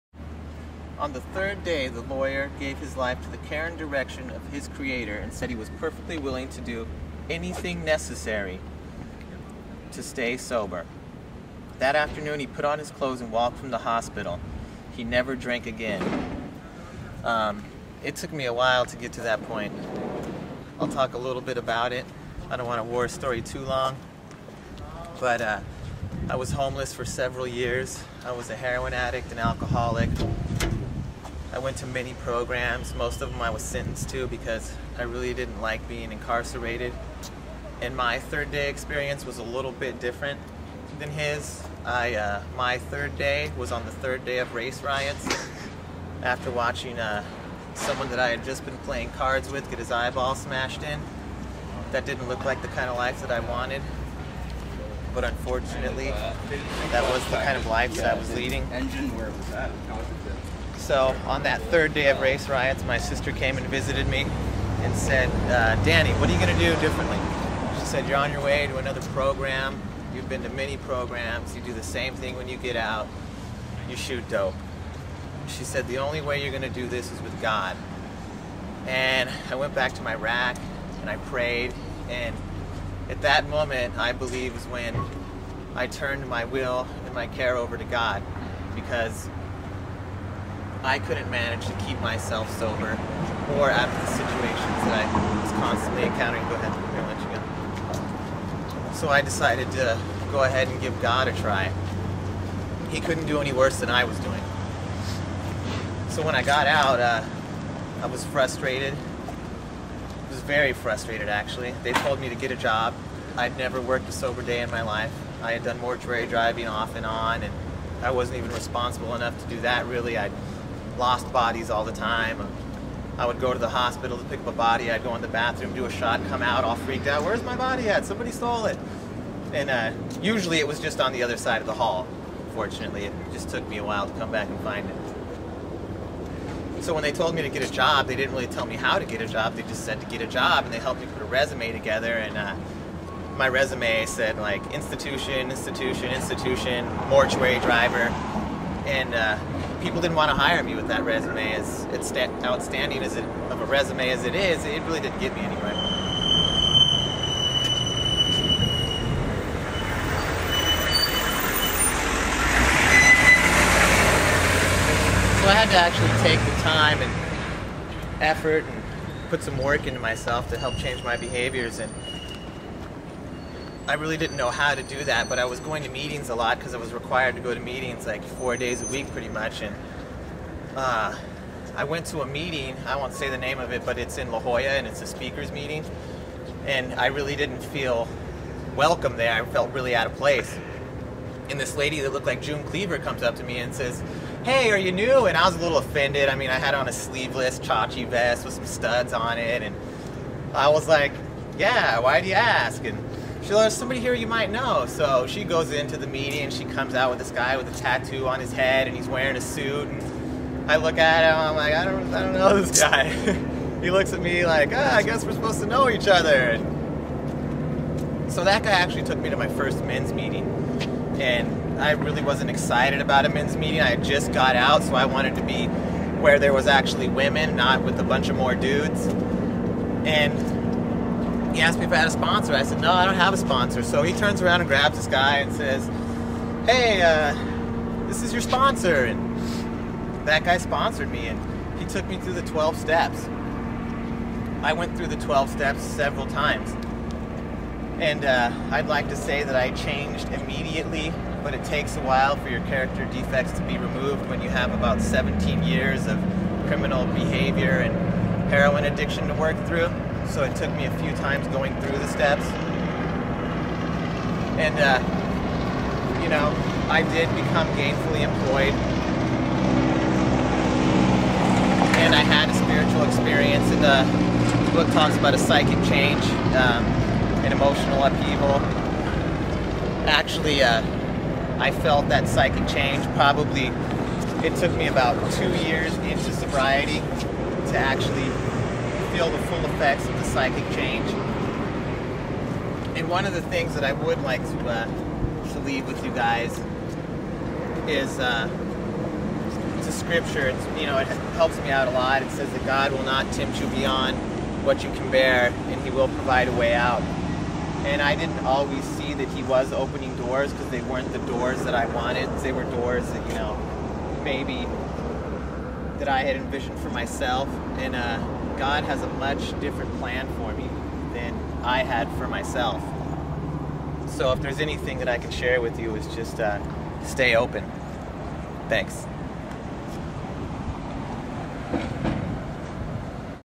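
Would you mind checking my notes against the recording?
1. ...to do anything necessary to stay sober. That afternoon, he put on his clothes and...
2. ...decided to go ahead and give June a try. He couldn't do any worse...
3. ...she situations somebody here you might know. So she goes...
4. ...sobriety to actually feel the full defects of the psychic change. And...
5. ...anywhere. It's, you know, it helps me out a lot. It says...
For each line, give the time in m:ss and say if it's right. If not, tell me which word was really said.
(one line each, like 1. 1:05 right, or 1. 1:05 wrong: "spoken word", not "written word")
1. 0:06 right
2. 1:39 wrong: "God", not "June"
3. 3:23 wrong: "learns", not "situations"
4. 4:46 wrong: "effects", not "defects"
5. 4:59 wrong: "scripture", not "anywhere".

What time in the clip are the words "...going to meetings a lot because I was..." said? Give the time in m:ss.
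2:55.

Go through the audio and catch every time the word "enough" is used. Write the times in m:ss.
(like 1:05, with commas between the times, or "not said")
1:59.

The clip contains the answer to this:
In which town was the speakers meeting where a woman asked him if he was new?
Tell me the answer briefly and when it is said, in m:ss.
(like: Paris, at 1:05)
La Jolla, at 3:04.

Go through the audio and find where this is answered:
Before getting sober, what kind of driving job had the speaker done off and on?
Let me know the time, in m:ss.
1:55.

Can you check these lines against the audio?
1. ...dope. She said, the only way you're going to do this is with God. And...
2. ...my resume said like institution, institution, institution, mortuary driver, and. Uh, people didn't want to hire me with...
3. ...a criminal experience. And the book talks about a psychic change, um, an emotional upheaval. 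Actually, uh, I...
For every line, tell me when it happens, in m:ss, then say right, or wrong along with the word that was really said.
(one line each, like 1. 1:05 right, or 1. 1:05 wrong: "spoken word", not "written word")
1. 1:14 right
2. 2:23 right
3. 4:32 wrong: "spiritual", not "criminal".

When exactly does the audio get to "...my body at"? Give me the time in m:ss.
2:07.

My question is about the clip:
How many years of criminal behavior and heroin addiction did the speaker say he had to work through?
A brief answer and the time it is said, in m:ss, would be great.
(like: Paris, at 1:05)
17, at 4:15.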